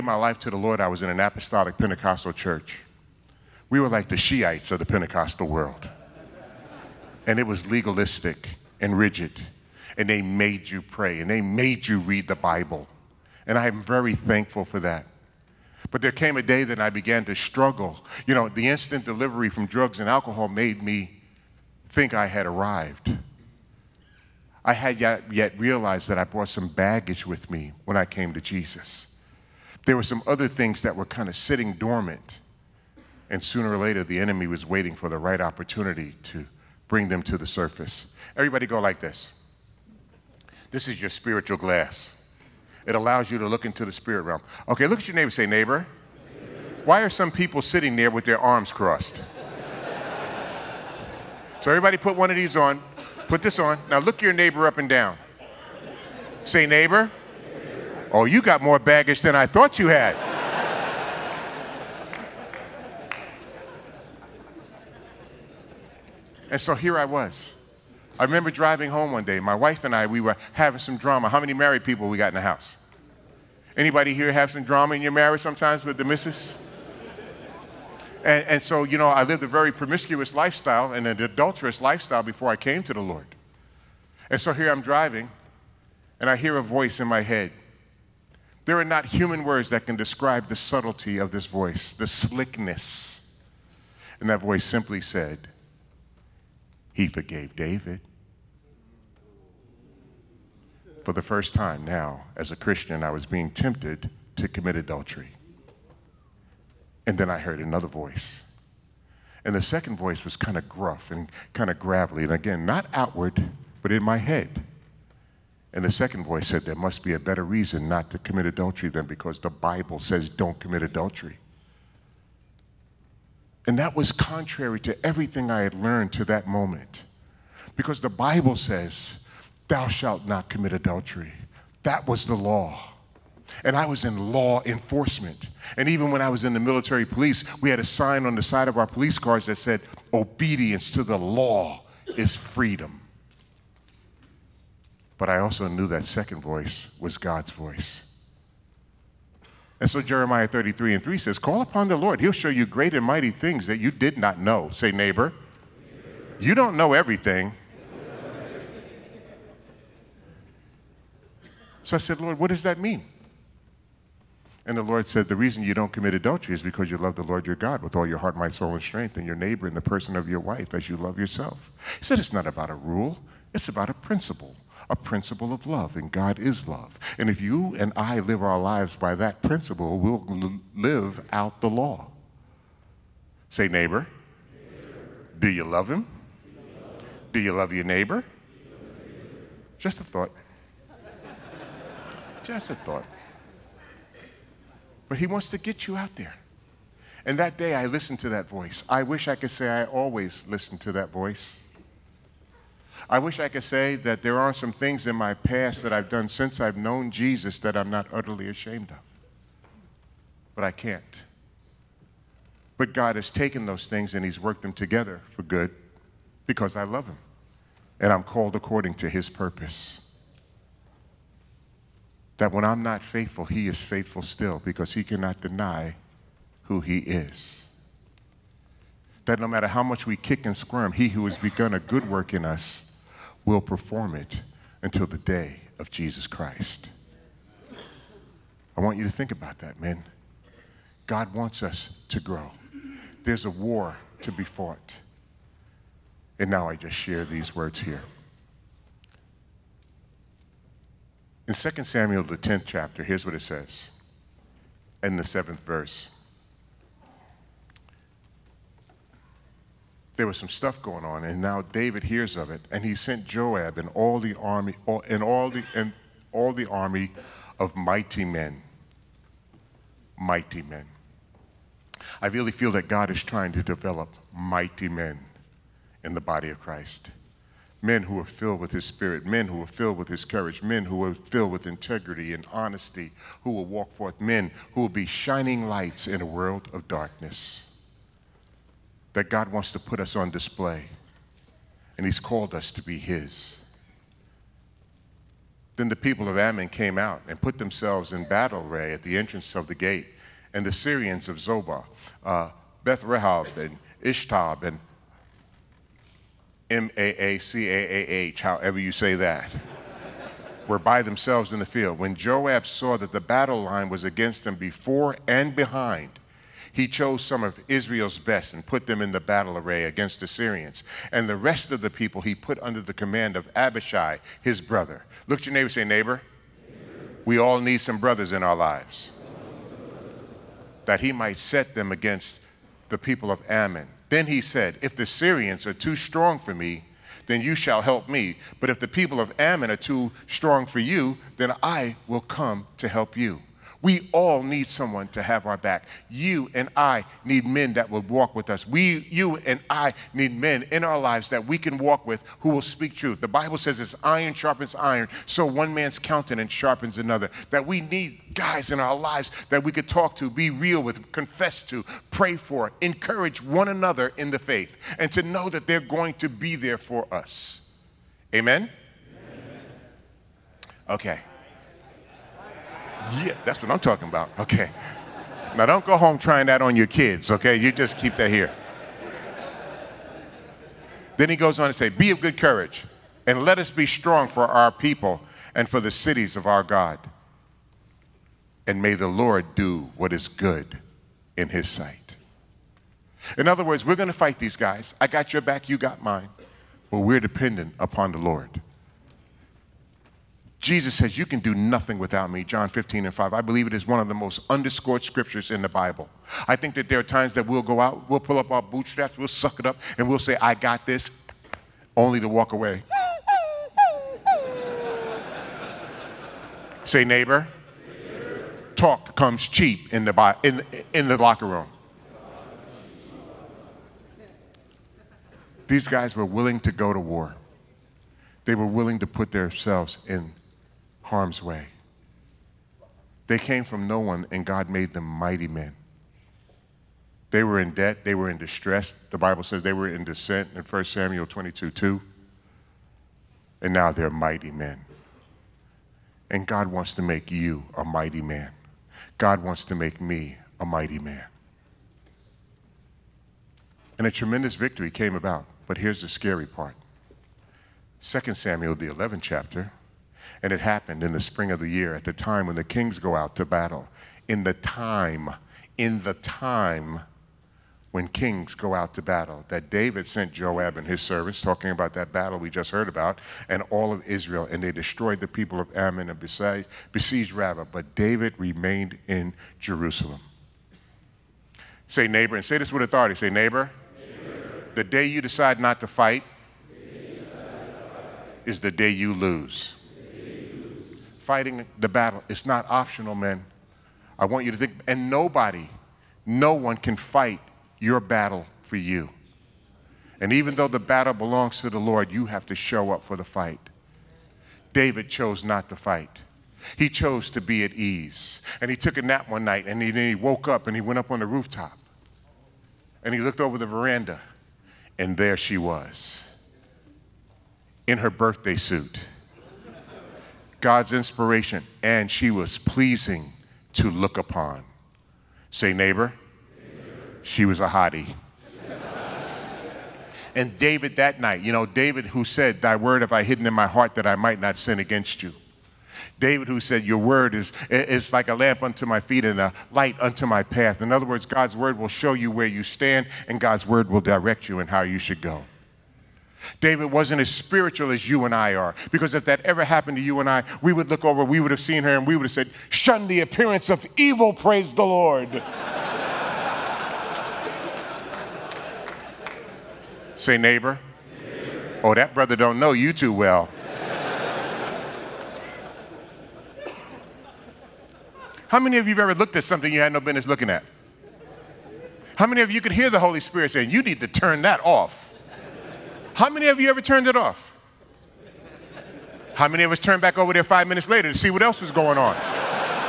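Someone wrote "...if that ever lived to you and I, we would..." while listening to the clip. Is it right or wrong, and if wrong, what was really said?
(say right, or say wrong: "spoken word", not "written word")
wrong: "happened", not "lived".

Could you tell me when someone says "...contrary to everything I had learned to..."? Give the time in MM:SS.
02:04.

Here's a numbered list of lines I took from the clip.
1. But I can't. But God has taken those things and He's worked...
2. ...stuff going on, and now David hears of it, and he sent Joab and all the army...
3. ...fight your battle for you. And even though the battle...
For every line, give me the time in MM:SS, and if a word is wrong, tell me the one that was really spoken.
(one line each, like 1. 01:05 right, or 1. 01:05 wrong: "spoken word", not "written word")
1. 03:30 right
2. 04:20 right
3. 08:16 right.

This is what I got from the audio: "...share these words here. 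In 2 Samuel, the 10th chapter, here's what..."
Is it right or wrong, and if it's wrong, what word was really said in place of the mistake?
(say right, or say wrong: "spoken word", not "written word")
right.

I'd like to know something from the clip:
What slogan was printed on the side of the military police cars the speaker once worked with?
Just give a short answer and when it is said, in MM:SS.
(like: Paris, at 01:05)
Obedience to the law is freedom, at 02:20.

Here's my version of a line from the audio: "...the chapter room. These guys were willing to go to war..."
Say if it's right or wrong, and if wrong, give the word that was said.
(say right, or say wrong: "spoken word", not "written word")
wrong: "locker", not "chapter".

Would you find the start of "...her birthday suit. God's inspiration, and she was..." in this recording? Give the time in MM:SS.
08:37.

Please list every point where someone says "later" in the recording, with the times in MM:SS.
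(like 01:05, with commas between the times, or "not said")
00:33, 09:40.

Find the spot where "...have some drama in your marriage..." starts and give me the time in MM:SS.
01:14.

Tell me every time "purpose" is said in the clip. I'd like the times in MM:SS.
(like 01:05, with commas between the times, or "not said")
03:39.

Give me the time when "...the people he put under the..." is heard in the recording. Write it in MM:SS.
05:21.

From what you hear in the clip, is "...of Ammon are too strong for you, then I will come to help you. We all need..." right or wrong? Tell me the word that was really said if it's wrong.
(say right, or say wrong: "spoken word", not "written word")
right.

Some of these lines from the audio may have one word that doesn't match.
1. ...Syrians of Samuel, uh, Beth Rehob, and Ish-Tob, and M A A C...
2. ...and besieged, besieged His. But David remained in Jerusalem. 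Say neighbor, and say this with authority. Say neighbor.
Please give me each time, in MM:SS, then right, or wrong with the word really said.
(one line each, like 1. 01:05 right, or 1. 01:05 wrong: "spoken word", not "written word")
1. 05:00 wrong: "Zobah", not "Samuel"
2. 07:56 wrong: "Rabbah", not "His".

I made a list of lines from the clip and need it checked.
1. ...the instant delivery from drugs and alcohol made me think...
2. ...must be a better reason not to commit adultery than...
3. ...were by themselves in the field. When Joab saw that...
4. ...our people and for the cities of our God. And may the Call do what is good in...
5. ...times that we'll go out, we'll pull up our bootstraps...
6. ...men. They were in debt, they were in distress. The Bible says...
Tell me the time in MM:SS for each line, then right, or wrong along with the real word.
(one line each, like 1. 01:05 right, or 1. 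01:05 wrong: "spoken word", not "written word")
1. 00:18 right
2. 01:56 right
3. 05:10 right
4. 06:24 wrong: "Lord", not "Call"
5. 06:47 right
6. 07:15 right.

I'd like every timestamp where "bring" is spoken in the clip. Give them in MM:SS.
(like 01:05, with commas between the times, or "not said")
00:36.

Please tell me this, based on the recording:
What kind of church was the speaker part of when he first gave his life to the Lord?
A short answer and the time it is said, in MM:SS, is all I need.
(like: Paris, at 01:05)
Apostolic Pentecostal, at 00:01.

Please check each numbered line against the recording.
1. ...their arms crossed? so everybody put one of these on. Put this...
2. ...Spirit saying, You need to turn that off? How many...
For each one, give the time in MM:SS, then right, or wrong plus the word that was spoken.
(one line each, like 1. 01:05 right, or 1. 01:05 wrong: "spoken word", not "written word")
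1. 00:48 right
2. 09:33 right.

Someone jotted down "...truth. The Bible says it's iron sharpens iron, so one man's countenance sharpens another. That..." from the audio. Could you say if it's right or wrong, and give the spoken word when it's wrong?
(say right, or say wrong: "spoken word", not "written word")
right.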